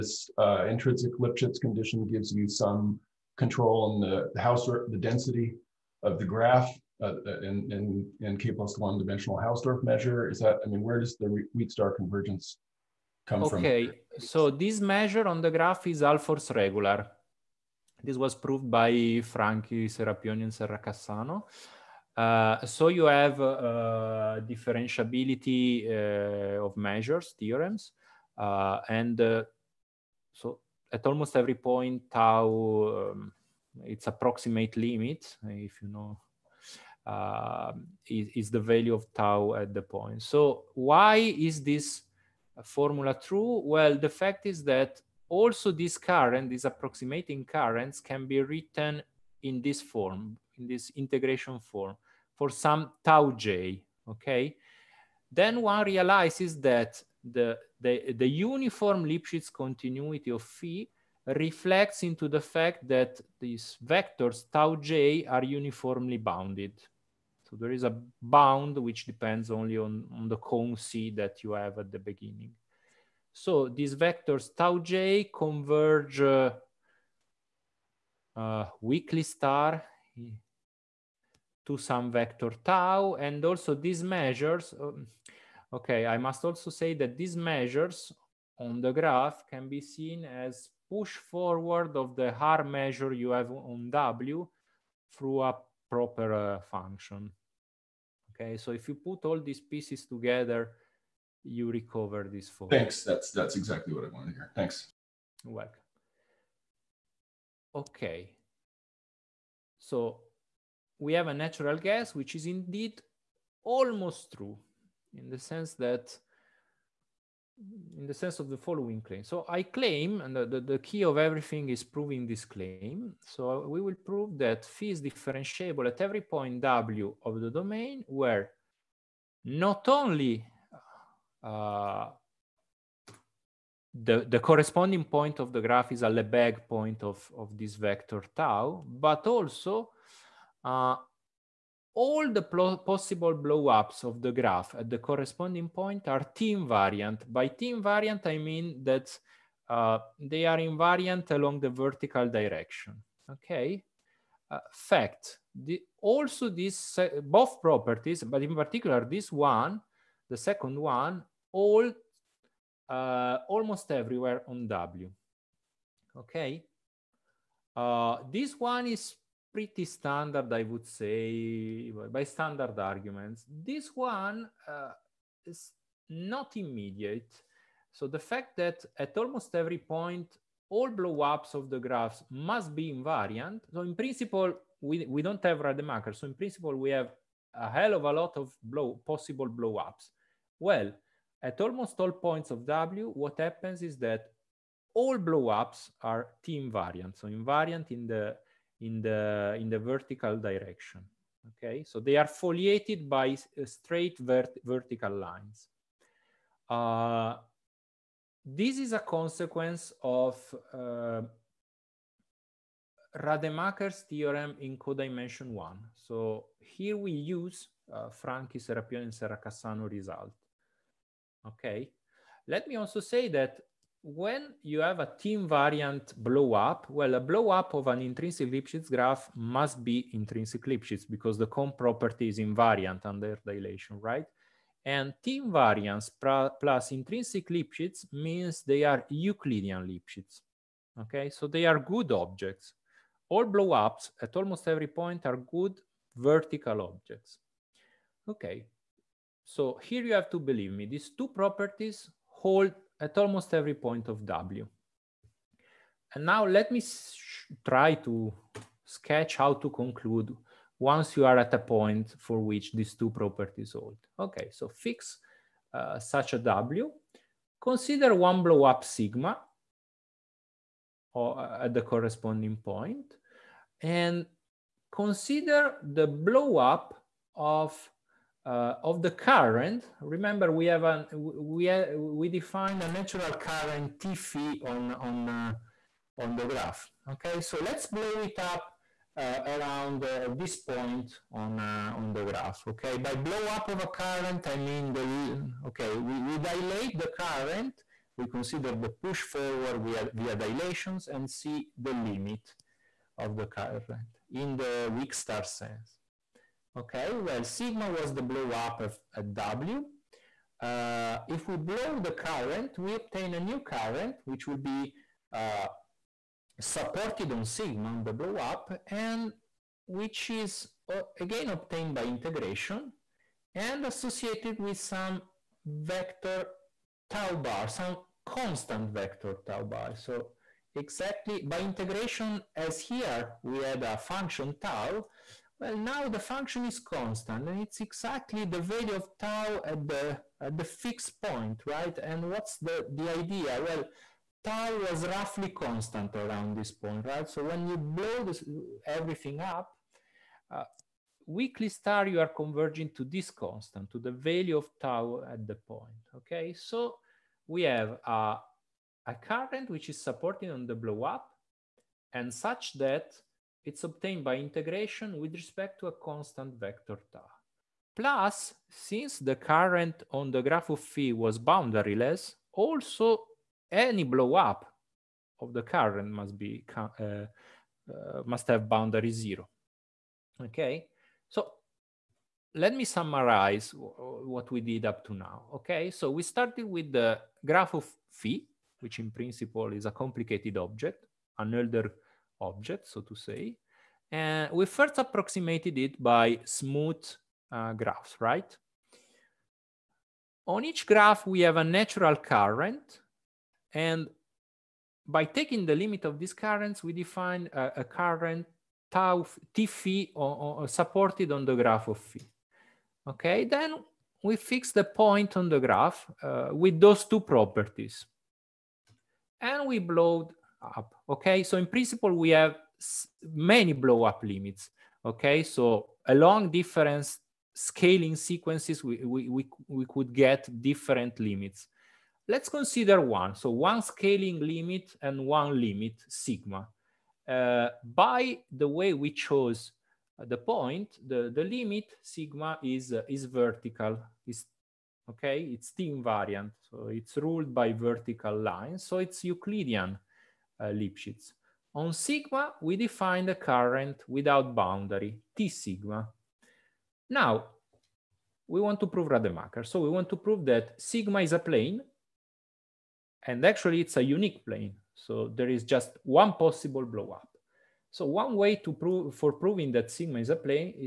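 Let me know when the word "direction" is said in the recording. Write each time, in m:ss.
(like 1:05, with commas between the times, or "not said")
2:32, 3:20.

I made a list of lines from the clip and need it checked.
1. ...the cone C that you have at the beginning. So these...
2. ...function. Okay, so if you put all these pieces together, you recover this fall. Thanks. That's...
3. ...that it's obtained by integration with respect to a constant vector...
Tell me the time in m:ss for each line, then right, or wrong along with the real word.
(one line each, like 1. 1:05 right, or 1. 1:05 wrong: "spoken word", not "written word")
1. 1:10 right
2. 1:36 right
3. 6:02 right.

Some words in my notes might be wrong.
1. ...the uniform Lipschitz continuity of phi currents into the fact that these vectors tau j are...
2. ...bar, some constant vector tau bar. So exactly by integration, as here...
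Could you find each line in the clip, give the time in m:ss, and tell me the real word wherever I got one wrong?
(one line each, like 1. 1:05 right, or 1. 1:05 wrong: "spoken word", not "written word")
1. 0:58 wrong: "reflects", not "currents"
2. 5:27 right.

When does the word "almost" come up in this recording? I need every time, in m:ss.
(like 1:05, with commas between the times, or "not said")
0:31, 1:53, 2:43, 2:59, 3:11, 4:04, 4:13.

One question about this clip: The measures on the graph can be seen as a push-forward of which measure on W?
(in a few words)
Haar measure.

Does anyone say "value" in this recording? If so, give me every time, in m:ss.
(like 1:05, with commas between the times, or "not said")
0:38, 5:38, 5:54.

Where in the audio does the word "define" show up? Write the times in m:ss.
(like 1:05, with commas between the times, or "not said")
4:42, 6:46, 7:32.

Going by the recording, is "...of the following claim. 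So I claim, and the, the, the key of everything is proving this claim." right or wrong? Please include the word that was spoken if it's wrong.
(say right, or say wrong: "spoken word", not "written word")
right.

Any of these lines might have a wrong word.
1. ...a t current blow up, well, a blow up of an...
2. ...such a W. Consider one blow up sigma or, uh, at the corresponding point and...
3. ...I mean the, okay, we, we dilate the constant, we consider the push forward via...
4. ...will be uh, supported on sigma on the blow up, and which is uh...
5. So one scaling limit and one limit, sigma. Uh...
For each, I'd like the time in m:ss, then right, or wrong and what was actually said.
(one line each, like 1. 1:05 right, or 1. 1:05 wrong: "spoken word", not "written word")
1. 3:44 wrong: "invariant", not "current"
2. 4:25 right
3. 4:54 wrong: "current", not "constant"
4. 5:14 right
5. 7:13 right.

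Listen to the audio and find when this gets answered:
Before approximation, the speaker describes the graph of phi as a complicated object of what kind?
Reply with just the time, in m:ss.
6:31.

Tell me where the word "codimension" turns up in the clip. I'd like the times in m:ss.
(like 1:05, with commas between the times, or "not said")
3:34.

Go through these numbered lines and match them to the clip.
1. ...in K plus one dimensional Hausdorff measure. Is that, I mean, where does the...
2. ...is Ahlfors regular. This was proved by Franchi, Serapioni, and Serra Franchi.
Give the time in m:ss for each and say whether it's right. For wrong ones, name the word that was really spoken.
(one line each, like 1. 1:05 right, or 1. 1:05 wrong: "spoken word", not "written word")
1. 0:08 right
2. 0:15 wrong: "Cassano", not "Franchi".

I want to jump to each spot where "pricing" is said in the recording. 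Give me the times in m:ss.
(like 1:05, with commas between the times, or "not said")
not said.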